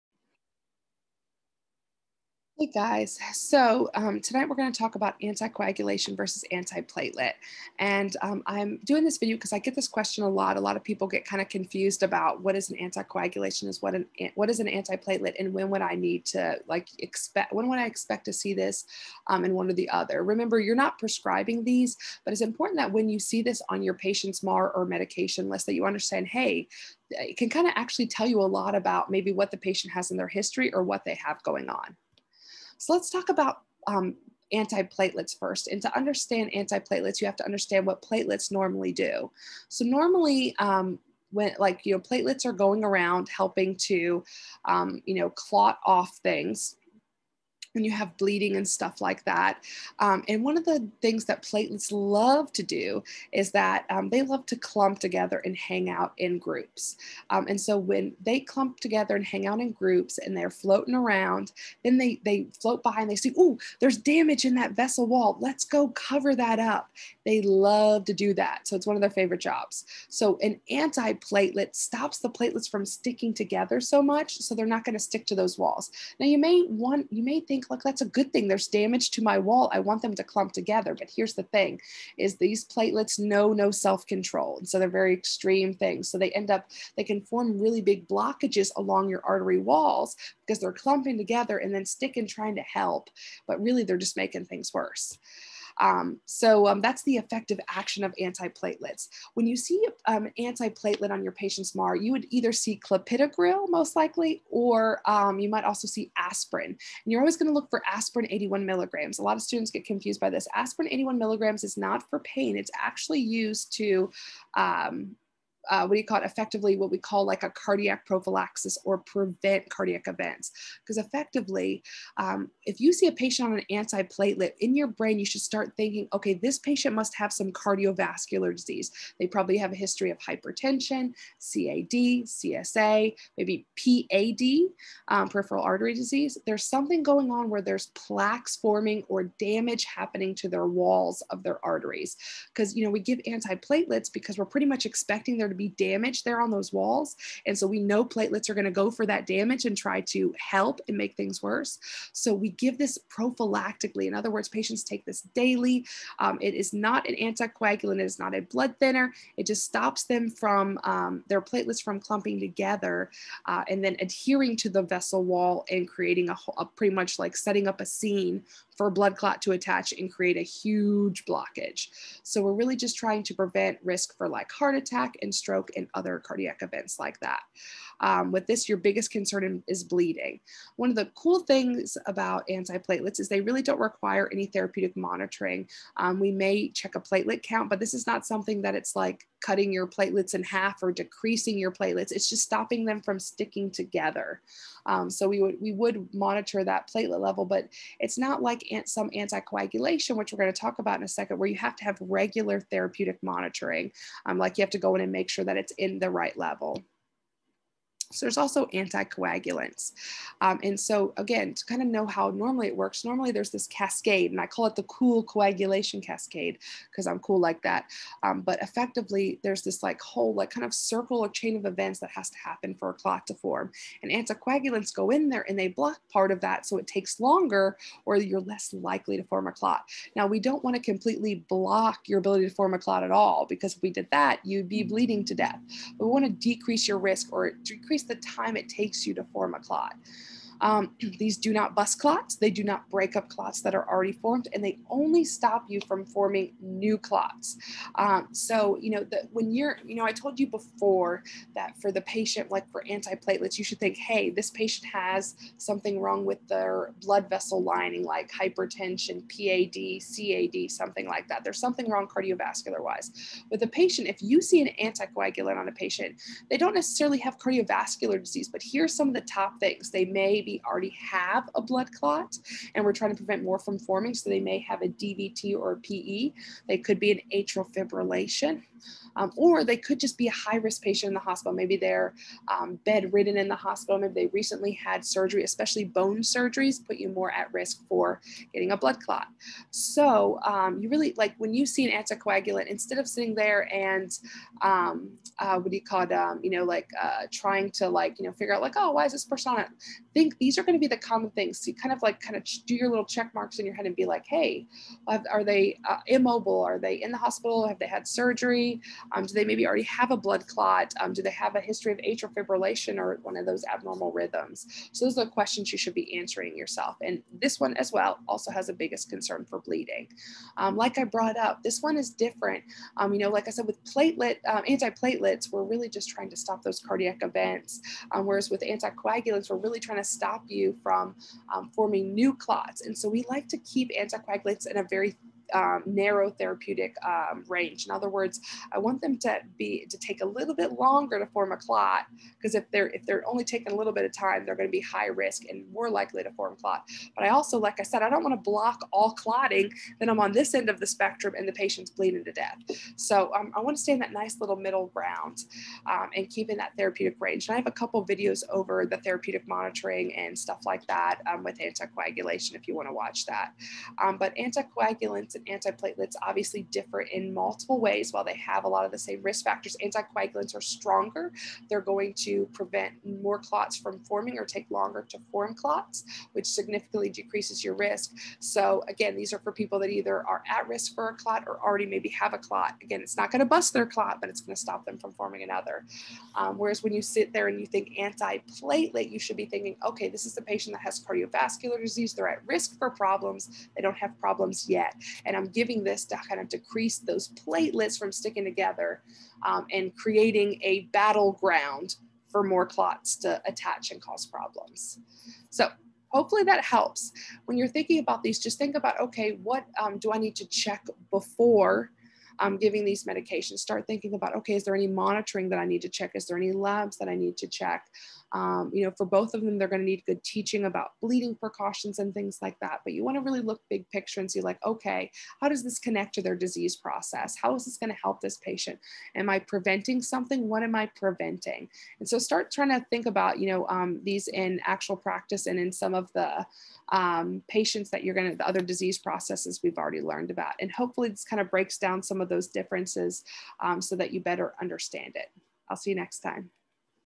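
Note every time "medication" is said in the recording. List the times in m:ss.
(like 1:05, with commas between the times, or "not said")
0:24, 6:53.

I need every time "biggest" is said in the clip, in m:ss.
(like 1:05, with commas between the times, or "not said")
2:58, 5:18.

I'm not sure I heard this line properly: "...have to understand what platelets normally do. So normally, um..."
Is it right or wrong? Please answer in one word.
right.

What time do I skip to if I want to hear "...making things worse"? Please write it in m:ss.
1:34.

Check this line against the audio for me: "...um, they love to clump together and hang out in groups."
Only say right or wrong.
right.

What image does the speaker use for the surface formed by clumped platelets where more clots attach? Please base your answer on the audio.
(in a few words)
a battleground.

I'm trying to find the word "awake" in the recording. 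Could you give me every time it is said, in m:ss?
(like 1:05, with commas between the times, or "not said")
not said.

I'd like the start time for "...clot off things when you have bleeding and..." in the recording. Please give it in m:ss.
0:45.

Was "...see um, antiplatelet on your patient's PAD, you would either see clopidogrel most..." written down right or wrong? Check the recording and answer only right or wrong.
wrong.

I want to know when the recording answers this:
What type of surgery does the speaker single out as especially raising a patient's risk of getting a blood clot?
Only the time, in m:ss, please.
4:45.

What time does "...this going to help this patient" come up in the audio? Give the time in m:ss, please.
7:07.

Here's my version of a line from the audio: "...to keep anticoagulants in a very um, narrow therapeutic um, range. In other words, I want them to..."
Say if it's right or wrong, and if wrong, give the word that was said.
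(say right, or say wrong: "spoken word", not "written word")
right.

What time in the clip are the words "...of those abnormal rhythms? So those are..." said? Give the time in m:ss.
5:13.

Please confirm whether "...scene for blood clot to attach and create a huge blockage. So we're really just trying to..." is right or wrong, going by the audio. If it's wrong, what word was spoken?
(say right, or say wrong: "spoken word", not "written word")
right.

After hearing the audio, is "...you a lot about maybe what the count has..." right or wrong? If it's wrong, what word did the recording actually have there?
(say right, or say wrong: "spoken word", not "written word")
wrong: "patient", not "count".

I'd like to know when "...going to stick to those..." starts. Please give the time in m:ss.
1:14.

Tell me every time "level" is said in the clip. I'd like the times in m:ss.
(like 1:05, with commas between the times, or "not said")
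3:17, 3:26.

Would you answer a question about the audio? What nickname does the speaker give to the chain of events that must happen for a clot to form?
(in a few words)
cool coagulation cascade.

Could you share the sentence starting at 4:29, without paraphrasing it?
They may be maybe already have a blood clot and we're trying to prevent more from forming.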